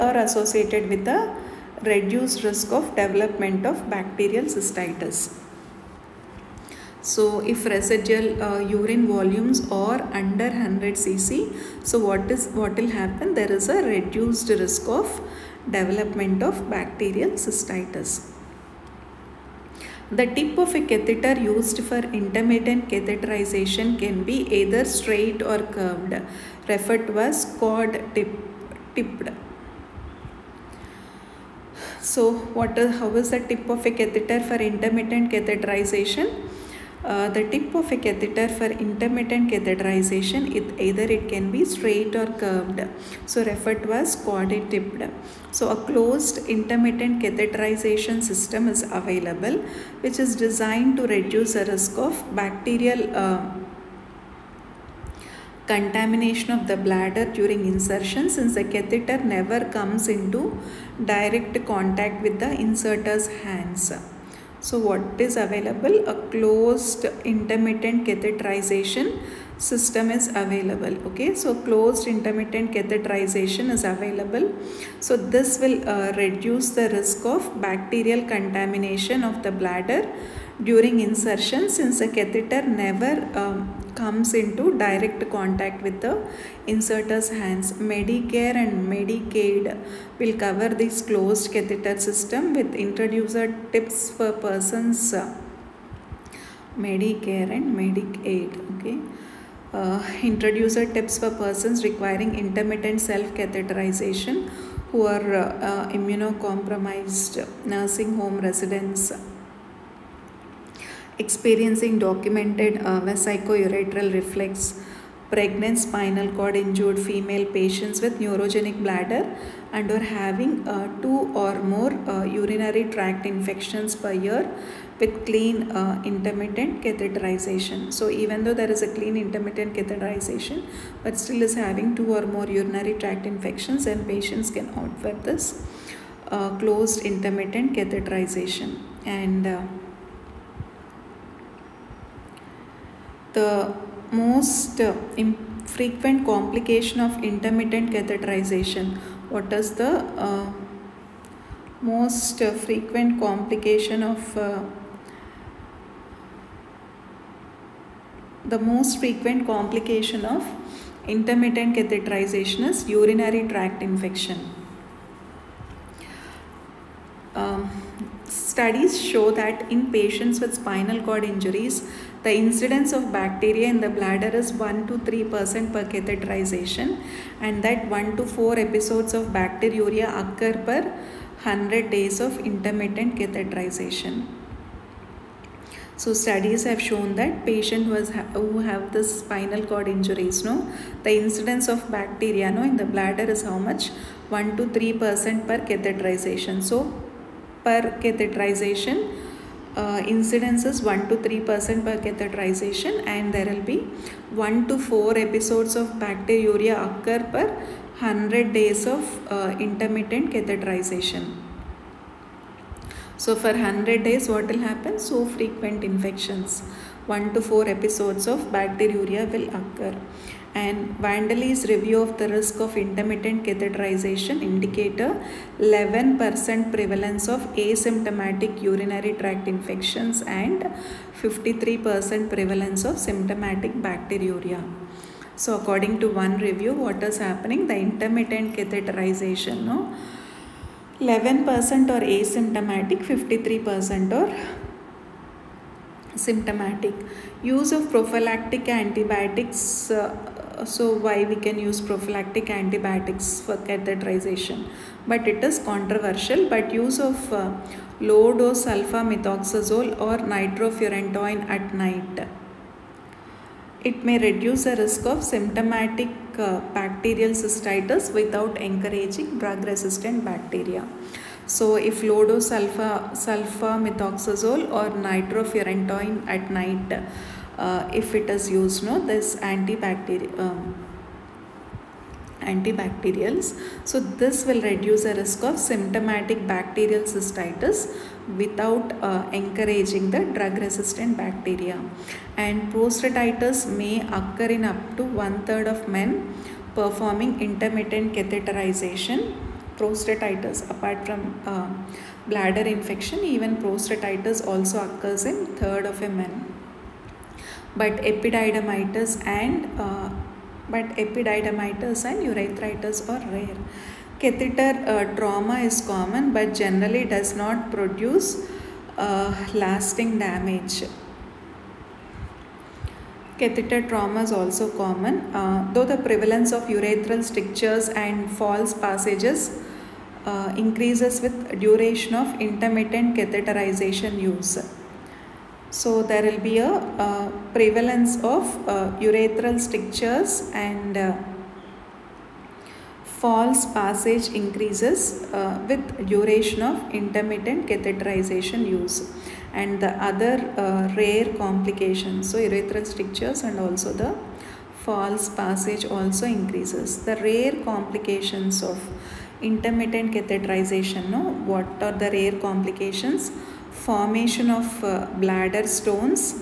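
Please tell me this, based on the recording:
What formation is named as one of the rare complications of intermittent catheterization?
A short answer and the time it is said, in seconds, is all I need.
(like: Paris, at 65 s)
bladder stones, at 365 s.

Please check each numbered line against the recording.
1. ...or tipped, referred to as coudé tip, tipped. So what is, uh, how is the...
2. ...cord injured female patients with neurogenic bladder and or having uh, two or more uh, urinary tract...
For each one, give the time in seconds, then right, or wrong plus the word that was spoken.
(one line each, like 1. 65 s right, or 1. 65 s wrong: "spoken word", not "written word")
1. 25 s wrong: "curved", not "tipped"
2. 116 s right.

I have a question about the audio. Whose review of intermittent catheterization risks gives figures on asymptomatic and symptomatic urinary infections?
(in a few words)
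Vandali.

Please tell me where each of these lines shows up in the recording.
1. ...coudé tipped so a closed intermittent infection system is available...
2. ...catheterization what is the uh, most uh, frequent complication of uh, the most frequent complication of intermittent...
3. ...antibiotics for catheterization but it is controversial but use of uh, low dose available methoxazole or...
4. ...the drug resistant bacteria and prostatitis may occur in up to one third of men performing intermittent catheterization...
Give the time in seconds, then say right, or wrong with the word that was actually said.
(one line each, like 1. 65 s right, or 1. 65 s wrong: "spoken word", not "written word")
1. 44 s wrong: "catheterization", not "infection"
2. 147 s right
3. 252 s wrong: "sulfamethoxazole", not "available"
4. 290 s right.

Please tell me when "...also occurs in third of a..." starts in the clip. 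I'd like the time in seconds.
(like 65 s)
304 s.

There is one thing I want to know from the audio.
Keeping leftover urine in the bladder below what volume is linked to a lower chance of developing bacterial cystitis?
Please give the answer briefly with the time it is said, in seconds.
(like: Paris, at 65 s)
100 cc, at 10 s.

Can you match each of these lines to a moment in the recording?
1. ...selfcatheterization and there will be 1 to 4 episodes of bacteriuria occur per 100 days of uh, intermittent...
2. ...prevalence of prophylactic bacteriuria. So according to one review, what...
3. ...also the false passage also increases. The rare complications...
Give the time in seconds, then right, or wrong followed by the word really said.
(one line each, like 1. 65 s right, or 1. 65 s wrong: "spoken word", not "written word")
1. 201 s wrong: "catheterization", not "selfcatheterization"
2. 232 s wrong: "symptomatic", not "prophylactic"
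3. 353 s right.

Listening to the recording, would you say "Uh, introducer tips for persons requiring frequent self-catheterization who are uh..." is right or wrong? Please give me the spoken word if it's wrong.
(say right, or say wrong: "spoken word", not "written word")
wrong: "intermittent", not "frequent".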